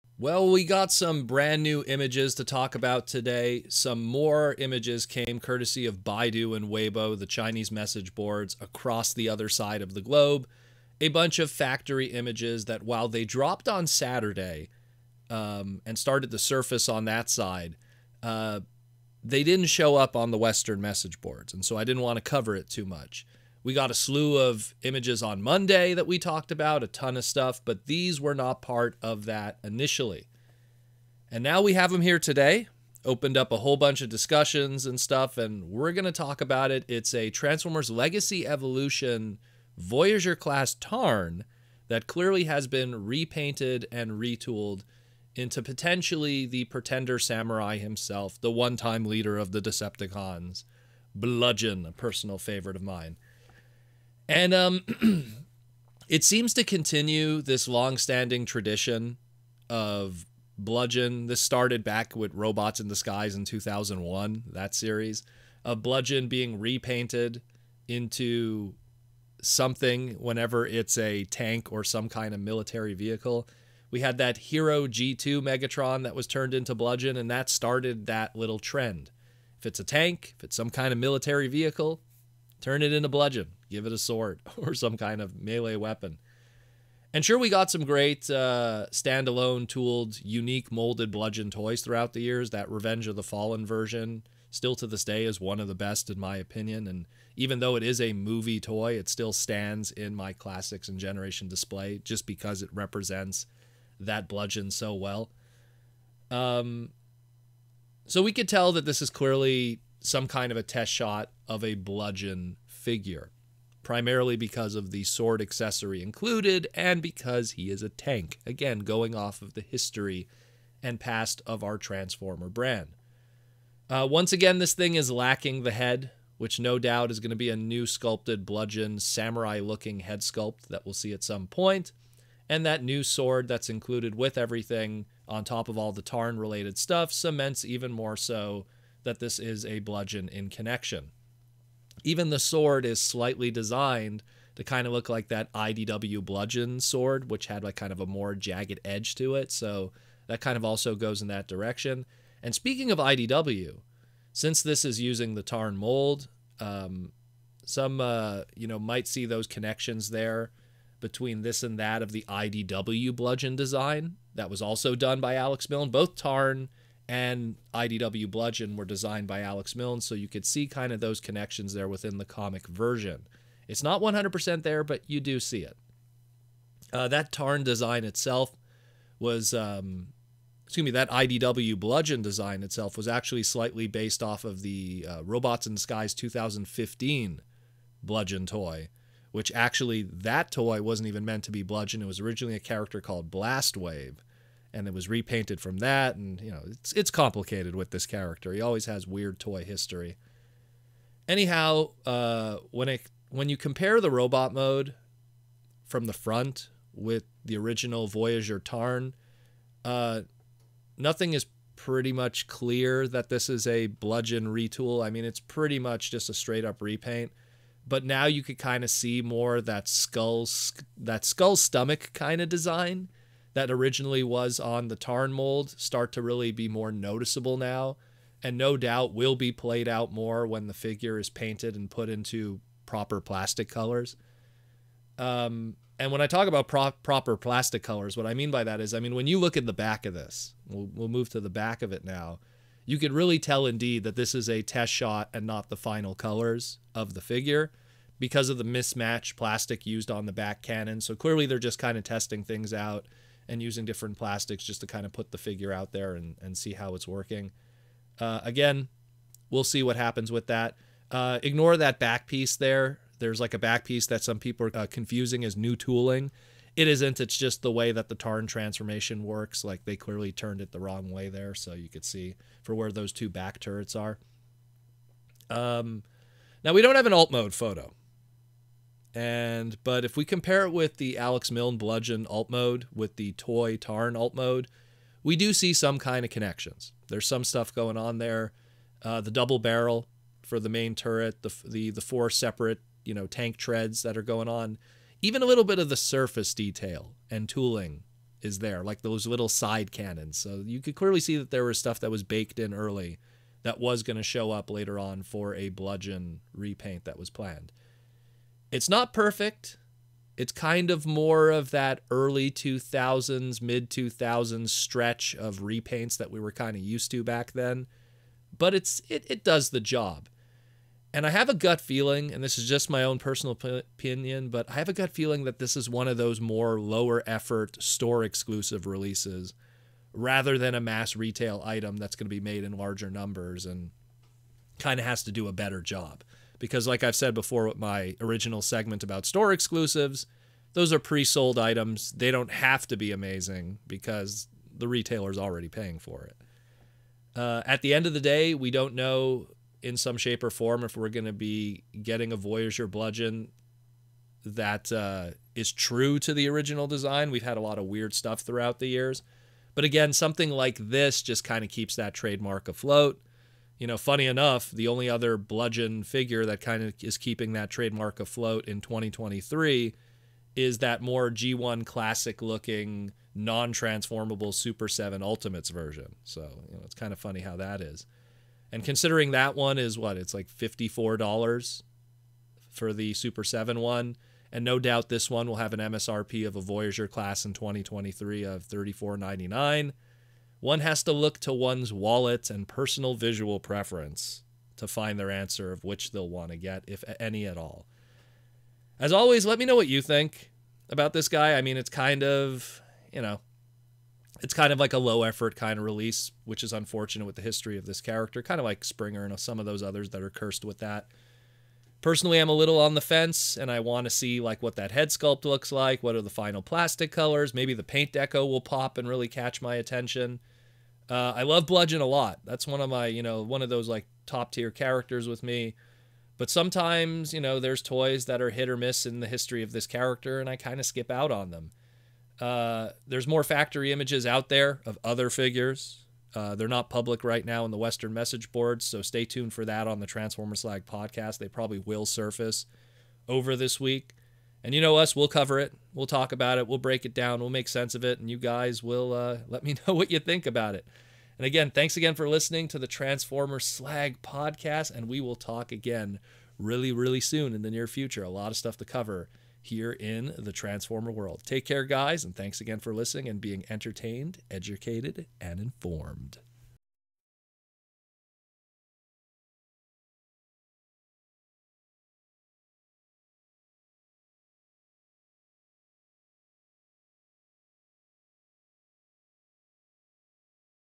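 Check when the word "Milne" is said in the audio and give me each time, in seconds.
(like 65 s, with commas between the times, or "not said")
165 s, 169 s, 281 s.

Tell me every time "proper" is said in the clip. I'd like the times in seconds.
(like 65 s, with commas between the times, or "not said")
232 s, 237 s.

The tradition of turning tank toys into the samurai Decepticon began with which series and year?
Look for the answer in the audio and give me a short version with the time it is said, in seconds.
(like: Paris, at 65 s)
Robots in Disguise 2001, at 63 s.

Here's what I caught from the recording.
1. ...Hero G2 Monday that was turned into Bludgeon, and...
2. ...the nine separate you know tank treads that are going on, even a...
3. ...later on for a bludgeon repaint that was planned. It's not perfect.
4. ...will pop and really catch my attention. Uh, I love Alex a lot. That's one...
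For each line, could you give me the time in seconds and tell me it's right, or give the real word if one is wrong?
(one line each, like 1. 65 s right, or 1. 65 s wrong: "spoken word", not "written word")
1. 74 s wrong: "Megatron", not "Monday"
2. 291 s wrong: "four", not "nine"
3. 304 s right
4. 418 s wrong: "Bludgeon", not "Alex".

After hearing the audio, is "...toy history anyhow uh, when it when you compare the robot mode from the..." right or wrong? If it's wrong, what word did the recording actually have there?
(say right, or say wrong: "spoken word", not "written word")
right.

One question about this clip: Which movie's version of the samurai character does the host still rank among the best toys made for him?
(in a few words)
Revenge of the Fallen.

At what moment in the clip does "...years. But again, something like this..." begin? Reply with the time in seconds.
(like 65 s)
358 s.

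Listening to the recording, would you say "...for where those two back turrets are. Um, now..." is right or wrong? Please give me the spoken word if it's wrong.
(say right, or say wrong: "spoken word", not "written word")
right.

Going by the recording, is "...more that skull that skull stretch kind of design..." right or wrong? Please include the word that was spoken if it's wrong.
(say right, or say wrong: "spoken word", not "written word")
wrong: "stomach", not "stretch".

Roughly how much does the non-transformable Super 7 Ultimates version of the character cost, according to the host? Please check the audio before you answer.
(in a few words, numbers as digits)
$54.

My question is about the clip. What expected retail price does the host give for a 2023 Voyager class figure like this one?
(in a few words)
$34.99.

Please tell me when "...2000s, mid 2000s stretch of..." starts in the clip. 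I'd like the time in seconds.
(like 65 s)
312 s.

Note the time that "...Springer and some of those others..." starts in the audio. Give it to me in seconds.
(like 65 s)
408 s.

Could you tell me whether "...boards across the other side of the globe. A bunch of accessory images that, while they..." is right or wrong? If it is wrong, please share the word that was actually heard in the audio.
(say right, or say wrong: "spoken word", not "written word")
wrong: "factory", not "accessory".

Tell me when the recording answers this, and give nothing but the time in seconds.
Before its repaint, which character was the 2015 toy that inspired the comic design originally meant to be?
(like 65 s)
193 s.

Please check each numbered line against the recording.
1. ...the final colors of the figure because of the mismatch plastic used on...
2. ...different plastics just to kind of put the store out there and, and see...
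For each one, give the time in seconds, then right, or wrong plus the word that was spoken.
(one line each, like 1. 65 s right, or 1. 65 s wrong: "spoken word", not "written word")
1. 245 s right
2. 253 s wrong: "figure", not "store".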